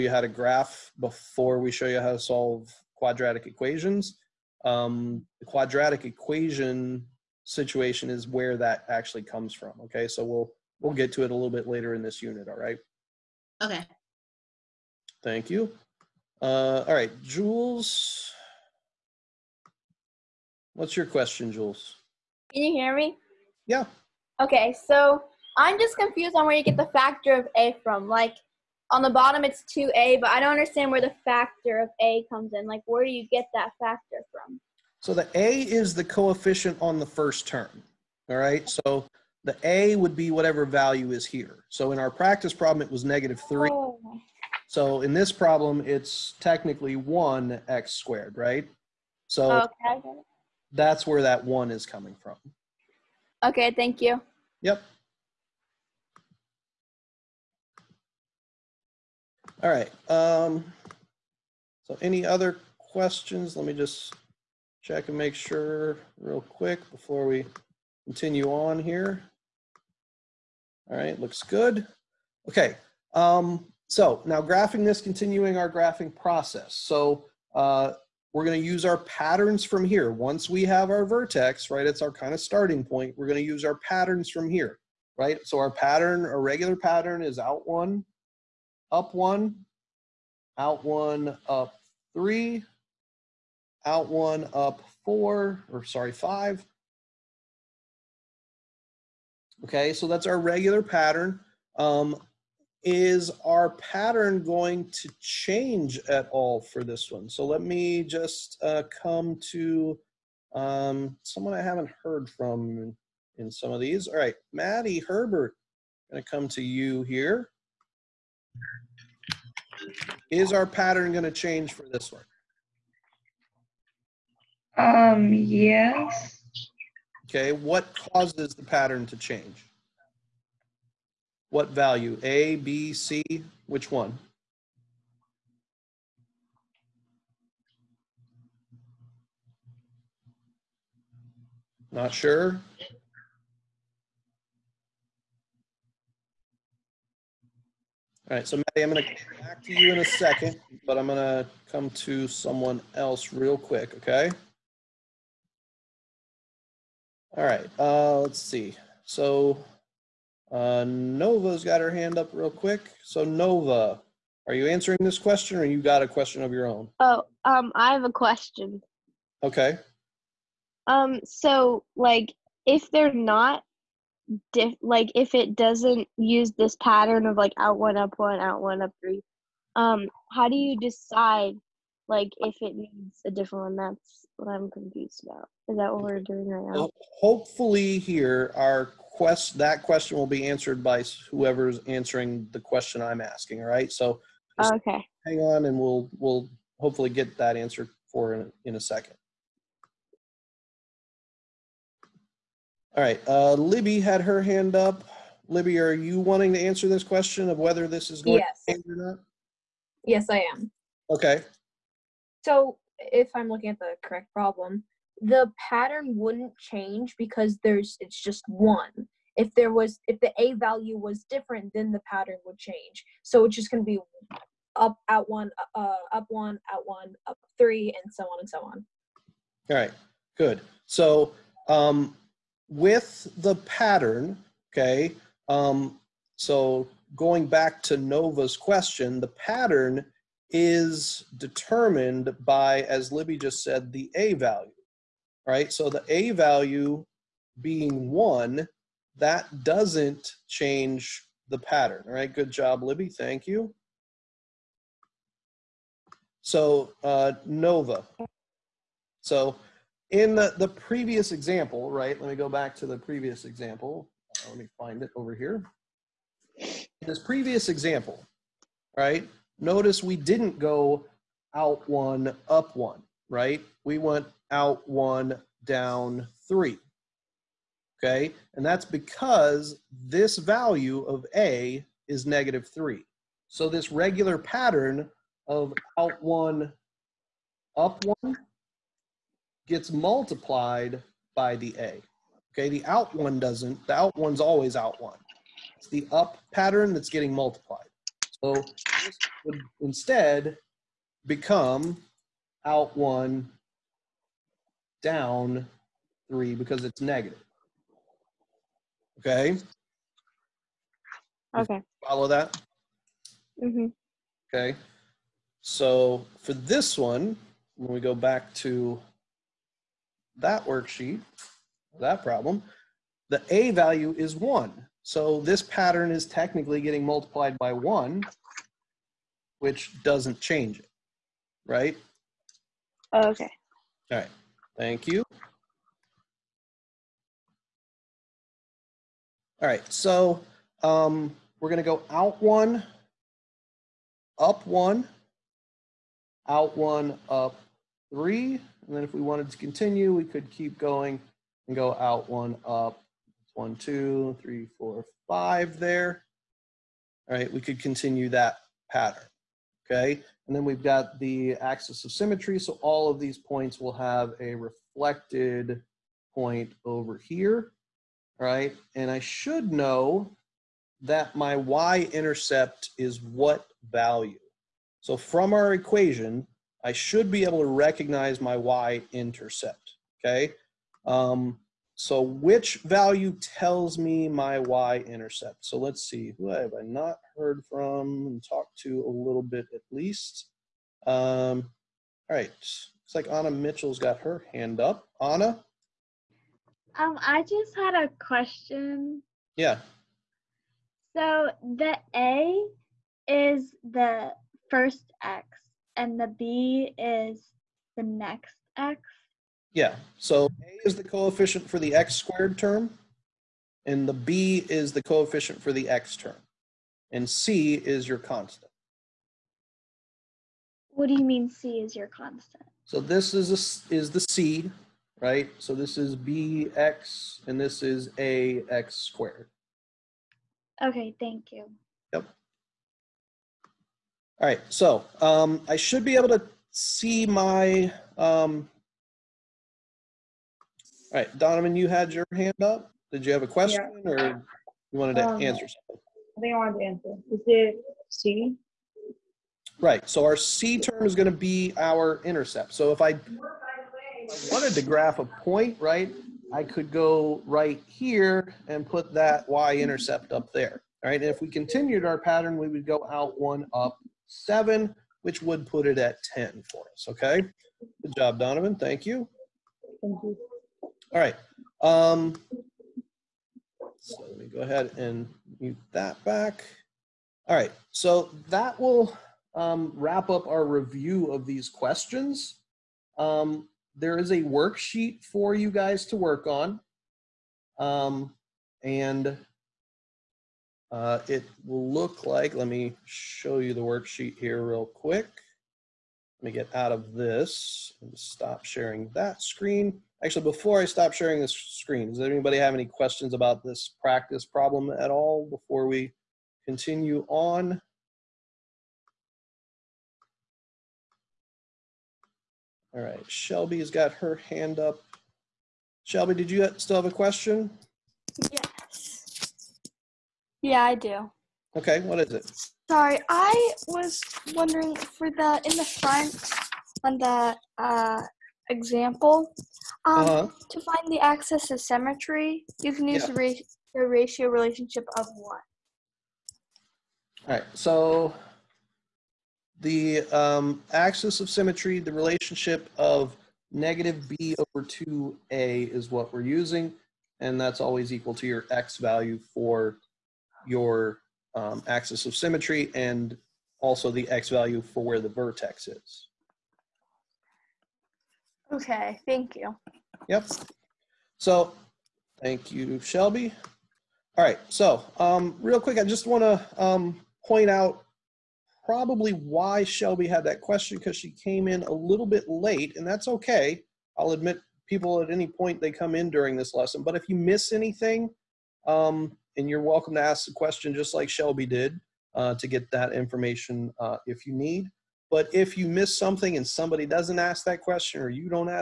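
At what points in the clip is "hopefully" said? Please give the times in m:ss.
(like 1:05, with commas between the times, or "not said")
3:07, 3:16.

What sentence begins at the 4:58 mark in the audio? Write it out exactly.
So this would instead become out one, down three because it's negative.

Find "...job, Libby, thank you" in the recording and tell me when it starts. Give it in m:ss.
4:12.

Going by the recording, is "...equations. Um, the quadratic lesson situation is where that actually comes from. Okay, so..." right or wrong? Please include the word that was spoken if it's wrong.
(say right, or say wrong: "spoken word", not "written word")
wrong: "equation", not "lesson".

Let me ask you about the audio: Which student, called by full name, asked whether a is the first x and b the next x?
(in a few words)
Anna Mitchell.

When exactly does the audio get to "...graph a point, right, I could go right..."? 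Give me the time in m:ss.
7:34.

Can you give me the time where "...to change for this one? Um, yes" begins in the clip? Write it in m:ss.
2:01.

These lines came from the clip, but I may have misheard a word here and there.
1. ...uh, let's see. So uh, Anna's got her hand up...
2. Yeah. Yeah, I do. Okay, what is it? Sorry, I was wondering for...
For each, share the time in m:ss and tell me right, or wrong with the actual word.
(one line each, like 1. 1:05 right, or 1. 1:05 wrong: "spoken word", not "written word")
1. 2:37 wrong: "Nova", not "Anna"
2. 8:38 right.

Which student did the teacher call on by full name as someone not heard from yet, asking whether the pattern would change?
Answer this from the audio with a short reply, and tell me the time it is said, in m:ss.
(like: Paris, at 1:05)
Maddie Herbert, at 1:54.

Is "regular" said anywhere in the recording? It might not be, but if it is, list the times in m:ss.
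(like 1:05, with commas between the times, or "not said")
1:26, 1:40, 4:43.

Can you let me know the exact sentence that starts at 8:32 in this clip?
All right, Shelby's got her hand up.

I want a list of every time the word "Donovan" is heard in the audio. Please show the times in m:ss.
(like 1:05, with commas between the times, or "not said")
7:21, 7:48.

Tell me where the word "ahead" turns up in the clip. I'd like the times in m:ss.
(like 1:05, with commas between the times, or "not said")
7:54.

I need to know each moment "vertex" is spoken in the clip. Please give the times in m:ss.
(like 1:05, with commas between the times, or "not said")
1:21, 9:15.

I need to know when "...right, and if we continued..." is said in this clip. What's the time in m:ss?
7:41.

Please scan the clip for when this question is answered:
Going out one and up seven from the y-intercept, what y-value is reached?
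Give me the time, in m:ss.
7:46.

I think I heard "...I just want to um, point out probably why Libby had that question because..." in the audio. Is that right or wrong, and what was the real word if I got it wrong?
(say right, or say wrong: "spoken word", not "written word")
wrong: "Shelby", not "Libby".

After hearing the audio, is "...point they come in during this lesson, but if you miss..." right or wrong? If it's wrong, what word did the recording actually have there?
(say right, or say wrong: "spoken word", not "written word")
right.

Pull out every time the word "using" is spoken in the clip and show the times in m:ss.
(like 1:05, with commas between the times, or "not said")
9:06.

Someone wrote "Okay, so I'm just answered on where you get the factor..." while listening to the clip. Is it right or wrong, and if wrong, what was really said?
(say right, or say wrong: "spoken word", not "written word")
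wrong: "confused", not "answered".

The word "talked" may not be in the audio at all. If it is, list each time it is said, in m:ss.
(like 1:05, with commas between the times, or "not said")
6:28.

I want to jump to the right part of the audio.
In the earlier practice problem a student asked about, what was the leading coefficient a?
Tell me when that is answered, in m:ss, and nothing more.
0:43.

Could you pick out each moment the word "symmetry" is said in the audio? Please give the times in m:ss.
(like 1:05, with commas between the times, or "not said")
6:02, 8:51, 9:01, 9:12.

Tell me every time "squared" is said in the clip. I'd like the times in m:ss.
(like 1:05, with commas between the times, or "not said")
0:47, 6:52, 7:08.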